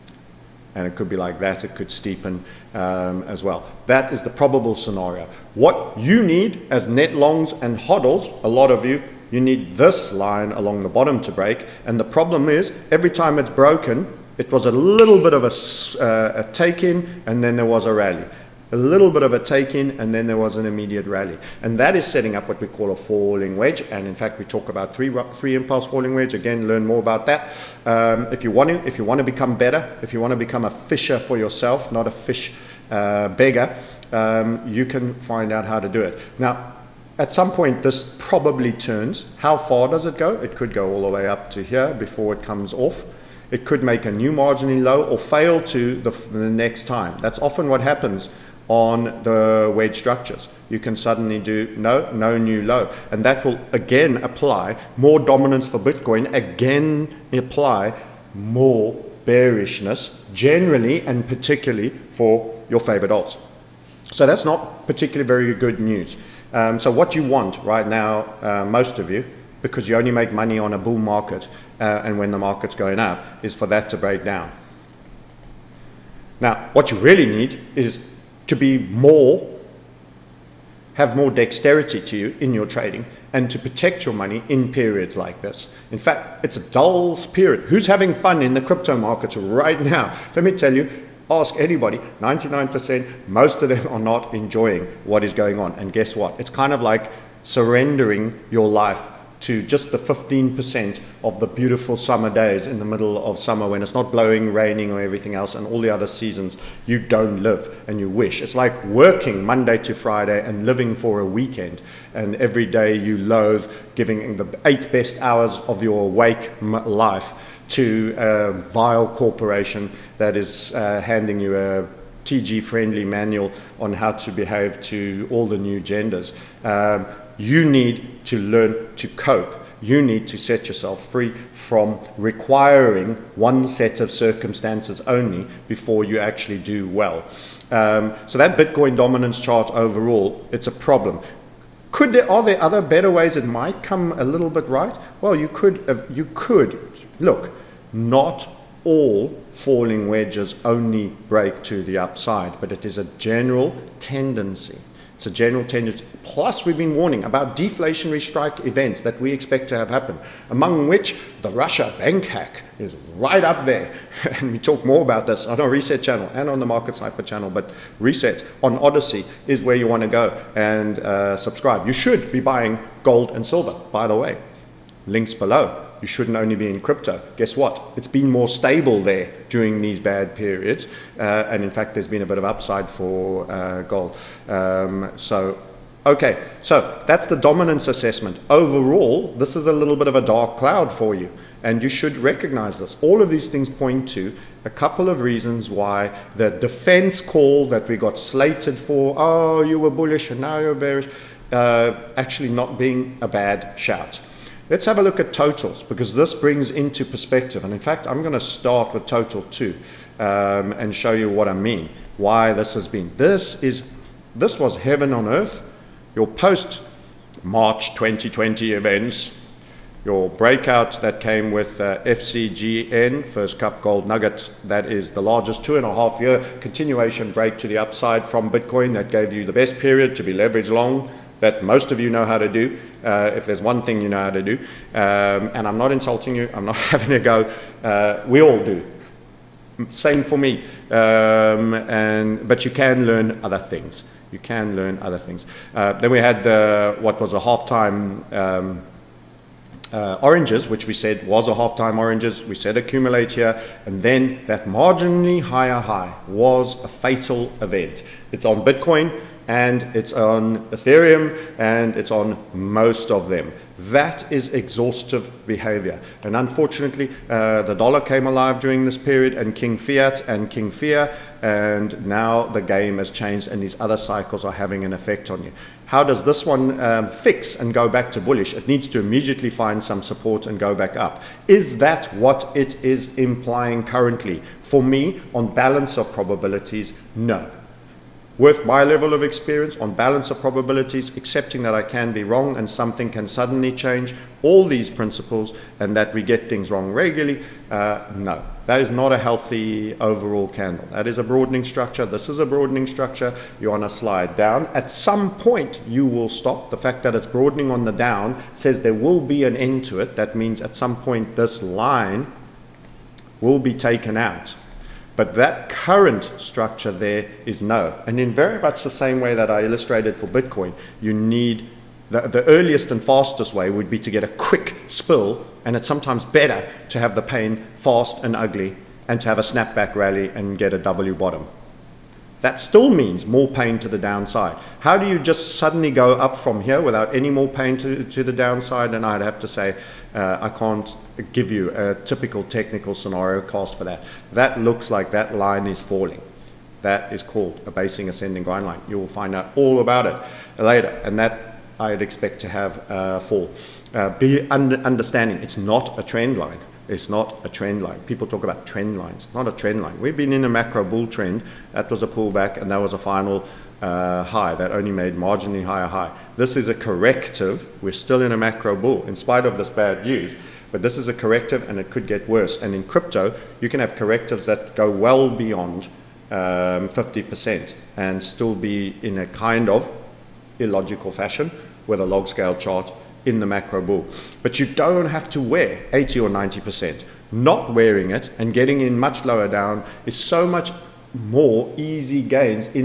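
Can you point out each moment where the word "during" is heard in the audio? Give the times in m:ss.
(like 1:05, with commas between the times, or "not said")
2:59, 4:28.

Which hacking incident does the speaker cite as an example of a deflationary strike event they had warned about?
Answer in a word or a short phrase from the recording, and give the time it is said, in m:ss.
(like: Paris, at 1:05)
Russia bank hack, at 2:41.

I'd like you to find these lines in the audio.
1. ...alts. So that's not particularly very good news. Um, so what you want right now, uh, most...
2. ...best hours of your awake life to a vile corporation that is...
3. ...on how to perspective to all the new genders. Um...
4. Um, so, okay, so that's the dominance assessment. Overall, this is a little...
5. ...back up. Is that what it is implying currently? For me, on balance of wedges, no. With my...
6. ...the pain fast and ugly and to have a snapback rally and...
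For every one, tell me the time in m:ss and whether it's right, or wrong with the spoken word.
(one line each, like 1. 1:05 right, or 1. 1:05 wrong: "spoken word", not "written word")
1. 1:03 right
2. 1:54 right
3. 2:03 wrong: "behave", not "perspective"
4. 3:04 right
5. 4:40 wrong: "probabilities", not "wedges"
6. 5:27 right.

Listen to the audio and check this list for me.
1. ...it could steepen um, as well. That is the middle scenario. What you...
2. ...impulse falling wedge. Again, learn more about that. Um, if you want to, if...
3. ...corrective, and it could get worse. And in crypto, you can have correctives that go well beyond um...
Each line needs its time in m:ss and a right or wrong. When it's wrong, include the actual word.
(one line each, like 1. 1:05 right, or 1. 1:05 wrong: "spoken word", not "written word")
1. 0:01 wrong: "probable", not "middle"
2. 0:25 right
3. 6:11 right.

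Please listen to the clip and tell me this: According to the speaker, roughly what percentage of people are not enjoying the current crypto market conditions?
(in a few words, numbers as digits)
99%.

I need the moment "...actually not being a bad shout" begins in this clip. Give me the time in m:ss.
3:22.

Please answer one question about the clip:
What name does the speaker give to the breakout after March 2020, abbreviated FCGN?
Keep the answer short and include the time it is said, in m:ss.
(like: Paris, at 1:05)
First Cup Gold Nuggets, at 3:43.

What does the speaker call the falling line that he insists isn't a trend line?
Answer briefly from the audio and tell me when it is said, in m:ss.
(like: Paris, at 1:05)
basing ascending grind line, at 5:47.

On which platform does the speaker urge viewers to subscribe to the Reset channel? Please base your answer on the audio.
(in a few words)
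Odysee.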